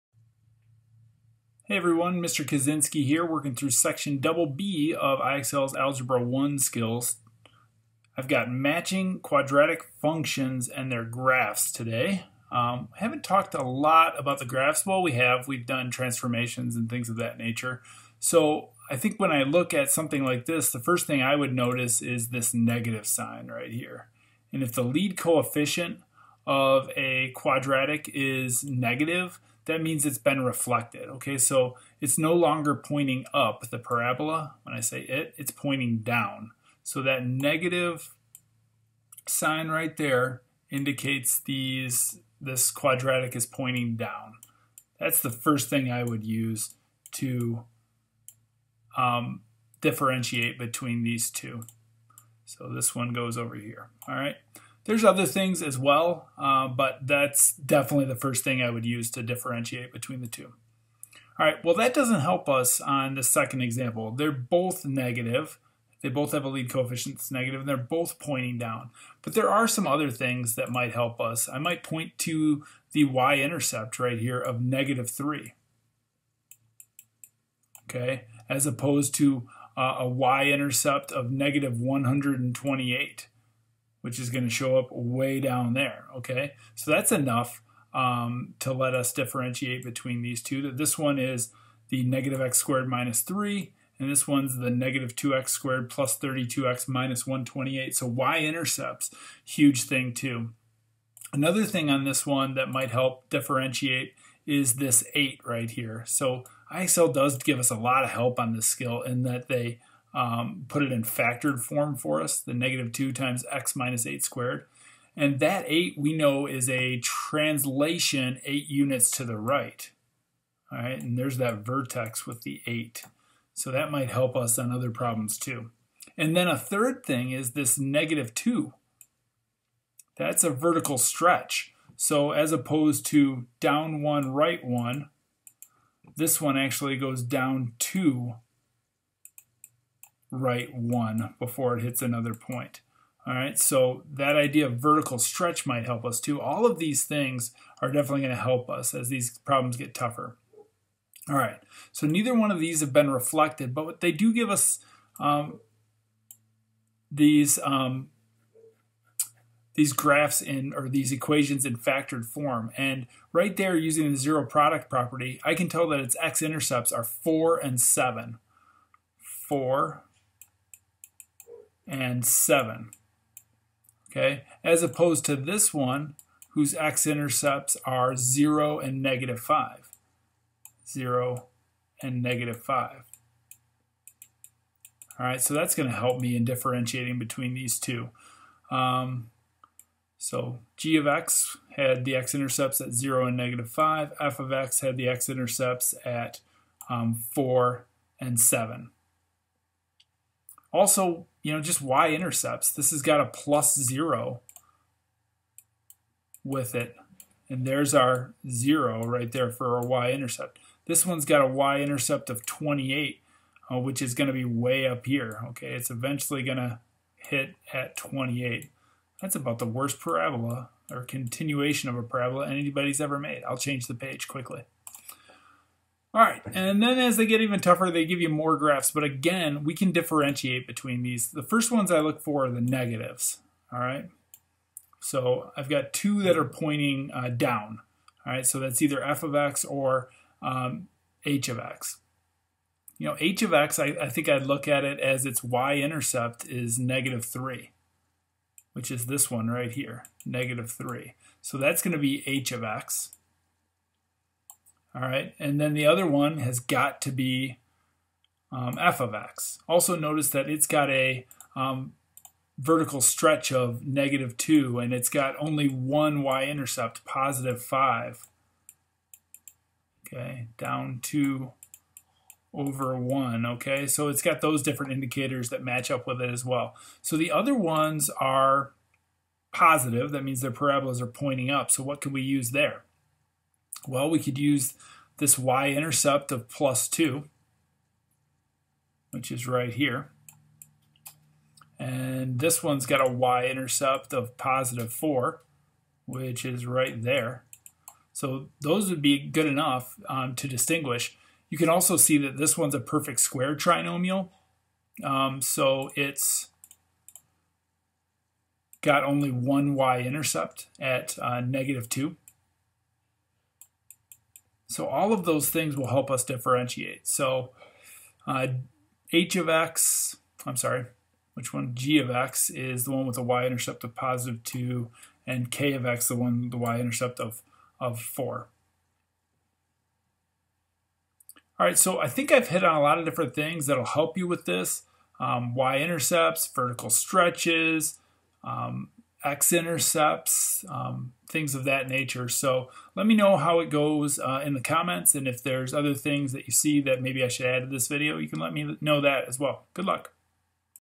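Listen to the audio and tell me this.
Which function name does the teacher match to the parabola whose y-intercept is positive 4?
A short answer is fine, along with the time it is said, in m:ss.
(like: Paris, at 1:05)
k of x, at 5:25.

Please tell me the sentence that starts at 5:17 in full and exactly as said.
So uh, h of x, I'm sorry, which one?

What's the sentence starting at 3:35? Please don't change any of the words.
Okay, it's eventually going to hit at 28.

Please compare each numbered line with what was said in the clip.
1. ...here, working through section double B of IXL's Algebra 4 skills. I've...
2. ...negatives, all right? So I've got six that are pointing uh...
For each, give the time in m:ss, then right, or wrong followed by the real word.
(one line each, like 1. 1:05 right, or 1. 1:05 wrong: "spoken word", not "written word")
1. 0:03 wrong: "1", not "4"
2. 3:52 wrong: "two", not "six".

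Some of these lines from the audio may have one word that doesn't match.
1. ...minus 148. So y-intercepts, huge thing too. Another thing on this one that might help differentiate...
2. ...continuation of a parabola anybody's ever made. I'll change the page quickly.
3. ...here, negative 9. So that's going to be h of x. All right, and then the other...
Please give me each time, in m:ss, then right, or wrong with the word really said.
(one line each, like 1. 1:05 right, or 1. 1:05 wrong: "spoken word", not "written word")
1. 1:36 wrong: "128", not "148"
2. 3:41 right
3. 4:09 wrong: "3", not "9".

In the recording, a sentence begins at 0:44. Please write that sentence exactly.
That's the first thing I would use to um, differentiate between these two.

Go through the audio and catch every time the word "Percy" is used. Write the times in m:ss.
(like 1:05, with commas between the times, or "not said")
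not said.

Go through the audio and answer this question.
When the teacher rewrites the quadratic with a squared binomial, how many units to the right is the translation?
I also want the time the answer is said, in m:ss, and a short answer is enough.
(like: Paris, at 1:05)
8, at 1:58.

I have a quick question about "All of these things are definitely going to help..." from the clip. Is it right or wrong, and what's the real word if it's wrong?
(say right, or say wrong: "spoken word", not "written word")
right.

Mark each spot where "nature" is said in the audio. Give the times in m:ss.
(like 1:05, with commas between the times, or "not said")
0:17, 5:41.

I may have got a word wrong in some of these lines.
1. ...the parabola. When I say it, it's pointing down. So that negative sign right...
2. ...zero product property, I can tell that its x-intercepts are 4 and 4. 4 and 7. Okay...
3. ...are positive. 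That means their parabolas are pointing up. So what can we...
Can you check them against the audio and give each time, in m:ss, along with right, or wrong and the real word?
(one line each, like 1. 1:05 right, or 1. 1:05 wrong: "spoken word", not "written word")
1. 0:33 right
2. 2:44 wrong: "7", not "4"
3. 4:38 right.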